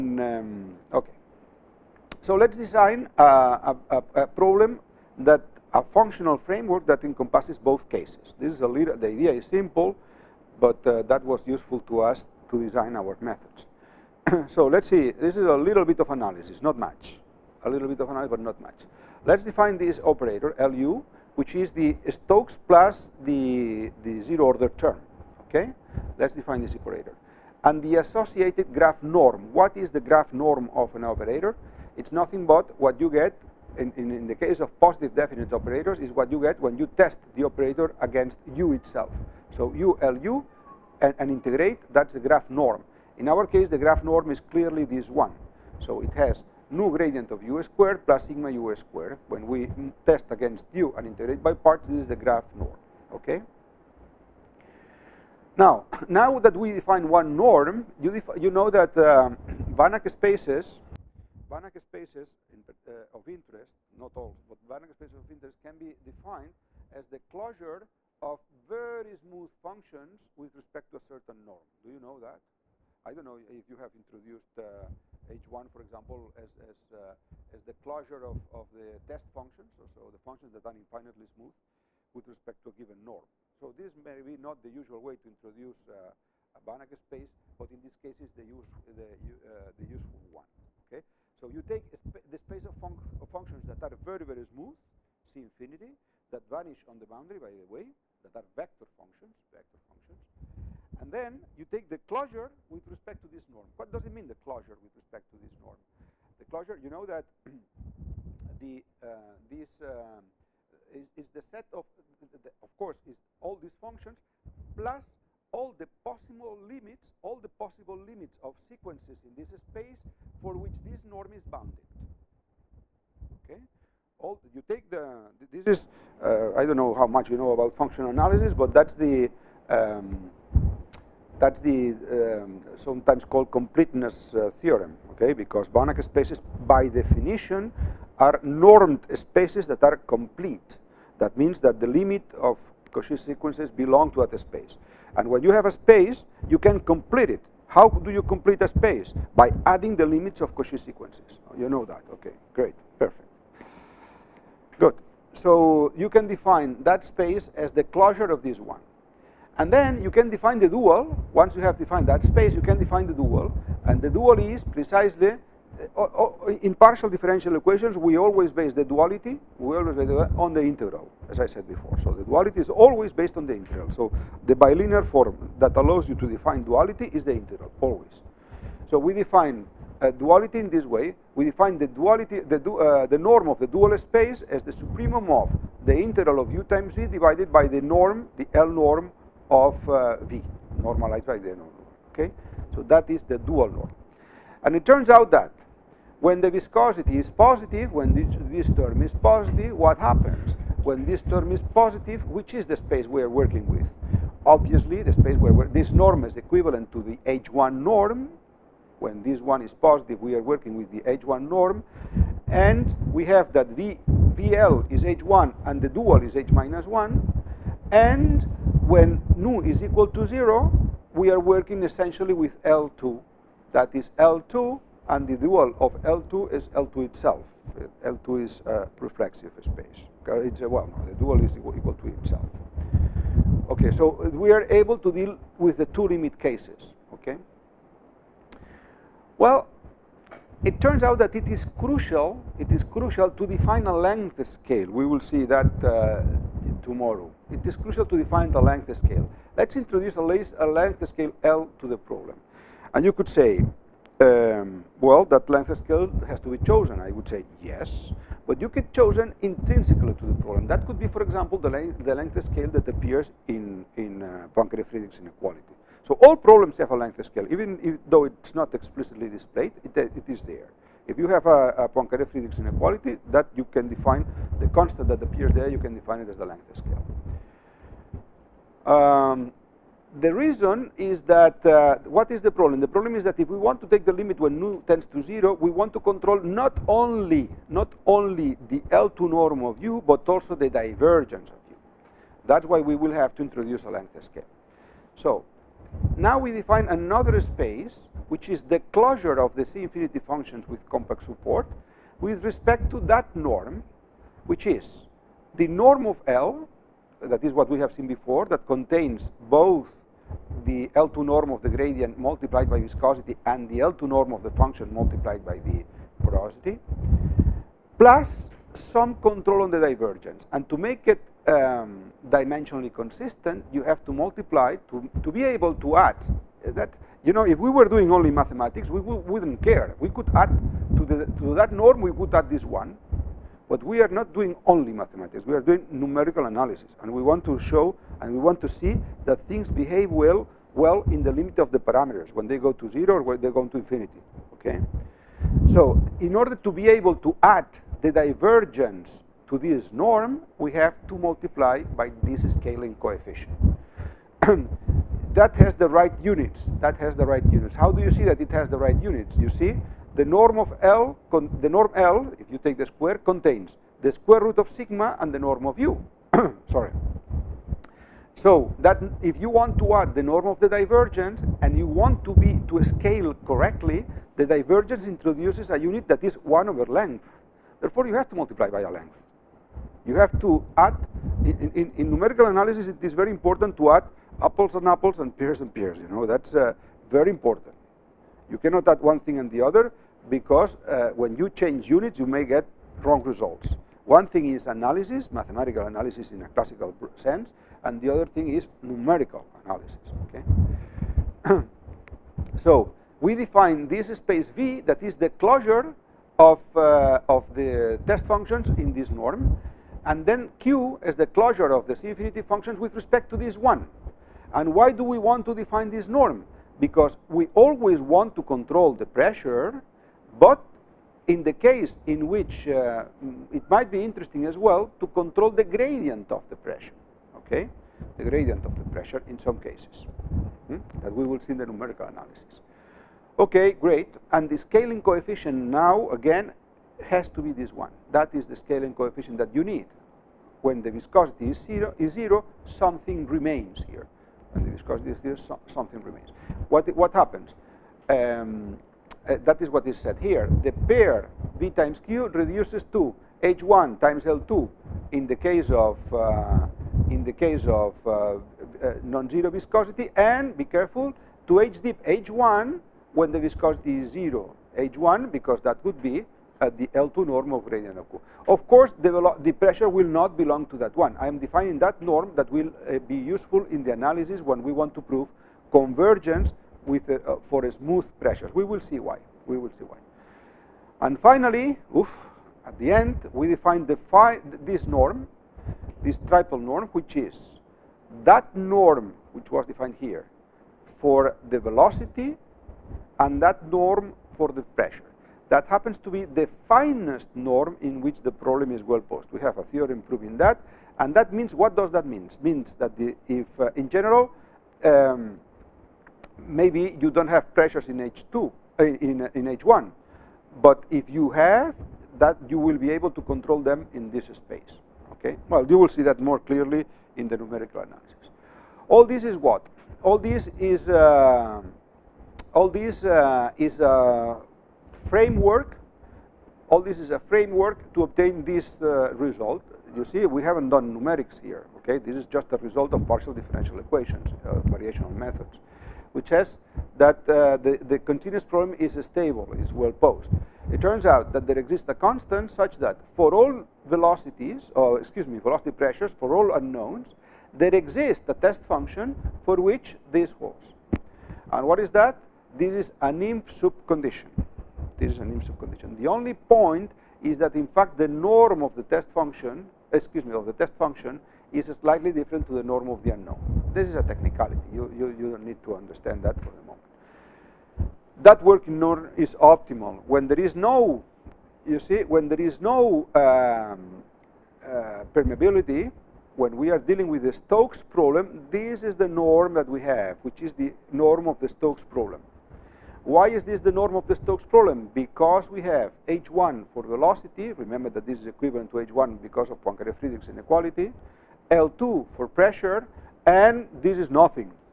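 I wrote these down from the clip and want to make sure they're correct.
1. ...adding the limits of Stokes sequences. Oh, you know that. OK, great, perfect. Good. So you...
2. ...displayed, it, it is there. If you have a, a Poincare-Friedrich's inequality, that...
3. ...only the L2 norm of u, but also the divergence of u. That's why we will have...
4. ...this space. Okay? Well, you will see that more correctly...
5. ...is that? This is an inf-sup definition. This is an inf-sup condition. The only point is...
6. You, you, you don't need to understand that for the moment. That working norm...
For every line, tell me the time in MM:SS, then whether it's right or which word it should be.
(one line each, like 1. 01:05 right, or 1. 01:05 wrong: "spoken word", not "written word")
1. 02:29 wrong: "Cauchy", not "Stokes"
2. 04:29 right
3. 04:48 right
4. 08:34 wrong: "clearly", not "correctly"
5. 09:11 wrong: "condition", not "definition"
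6. 09:24 right.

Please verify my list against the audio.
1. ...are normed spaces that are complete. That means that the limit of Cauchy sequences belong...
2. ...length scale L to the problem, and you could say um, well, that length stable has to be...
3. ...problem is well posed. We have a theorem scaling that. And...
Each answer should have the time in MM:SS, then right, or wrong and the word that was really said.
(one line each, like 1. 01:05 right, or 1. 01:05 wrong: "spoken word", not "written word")
1. 02:18 right
2. 04:10 wrong: "scale", not "stable"
3. 08:18 wrong: "proving", not "scaling".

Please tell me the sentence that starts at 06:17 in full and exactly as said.
Therefore, you have to multiply by a length.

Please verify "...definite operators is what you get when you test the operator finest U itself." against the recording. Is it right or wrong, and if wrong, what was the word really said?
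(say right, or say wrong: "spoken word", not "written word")
wrong: "against", not "finest".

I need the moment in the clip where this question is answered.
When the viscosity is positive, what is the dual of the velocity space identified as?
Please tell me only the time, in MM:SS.
03:36.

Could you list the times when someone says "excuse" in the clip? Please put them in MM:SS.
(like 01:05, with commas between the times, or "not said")
09:04, 09:19.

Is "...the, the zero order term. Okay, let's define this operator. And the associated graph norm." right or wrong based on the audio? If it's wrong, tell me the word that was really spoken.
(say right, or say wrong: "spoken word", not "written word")
right.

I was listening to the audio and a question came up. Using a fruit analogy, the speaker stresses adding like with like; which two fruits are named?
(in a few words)
apples and pears.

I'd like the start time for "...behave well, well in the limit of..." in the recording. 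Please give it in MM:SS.
05:39.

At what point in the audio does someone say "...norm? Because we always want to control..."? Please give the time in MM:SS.
06:56.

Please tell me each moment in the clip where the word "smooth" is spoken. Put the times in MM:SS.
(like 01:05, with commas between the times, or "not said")
01:09, 01:21, 01:34, 07:57.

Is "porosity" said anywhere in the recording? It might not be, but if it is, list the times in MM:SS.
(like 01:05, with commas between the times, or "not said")
05:16.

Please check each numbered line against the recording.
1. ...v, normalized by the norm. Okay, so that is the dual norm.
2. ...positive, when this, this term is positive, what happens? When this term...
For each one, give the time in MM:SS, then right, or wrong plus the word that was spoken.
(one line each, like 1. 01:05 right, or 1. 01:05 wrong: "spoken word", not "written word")
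1. 03:10 right
2. 03:17 right.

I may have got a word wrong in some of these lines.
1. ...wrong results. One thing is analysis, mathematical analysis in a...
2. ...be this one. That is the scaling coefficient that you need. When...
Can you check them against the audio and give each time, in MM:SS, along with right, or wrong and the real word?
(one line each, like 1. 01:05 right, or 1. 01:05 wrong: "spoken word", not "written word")
1. 06:33 right
2. 07:17 right.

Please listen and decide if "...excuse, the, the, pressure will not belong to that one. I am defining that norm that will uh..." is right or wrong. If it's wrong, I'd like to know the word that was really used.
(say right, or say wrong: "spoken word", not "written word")
wrong: "course", not "excuse".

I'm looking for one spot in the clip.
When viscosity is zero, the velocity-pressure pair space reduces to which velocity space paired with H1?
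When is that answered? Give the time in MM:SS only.
07:41.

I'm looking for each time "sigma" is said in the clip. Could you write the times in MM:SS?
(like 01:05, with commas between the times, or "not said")
00:48, 06:04.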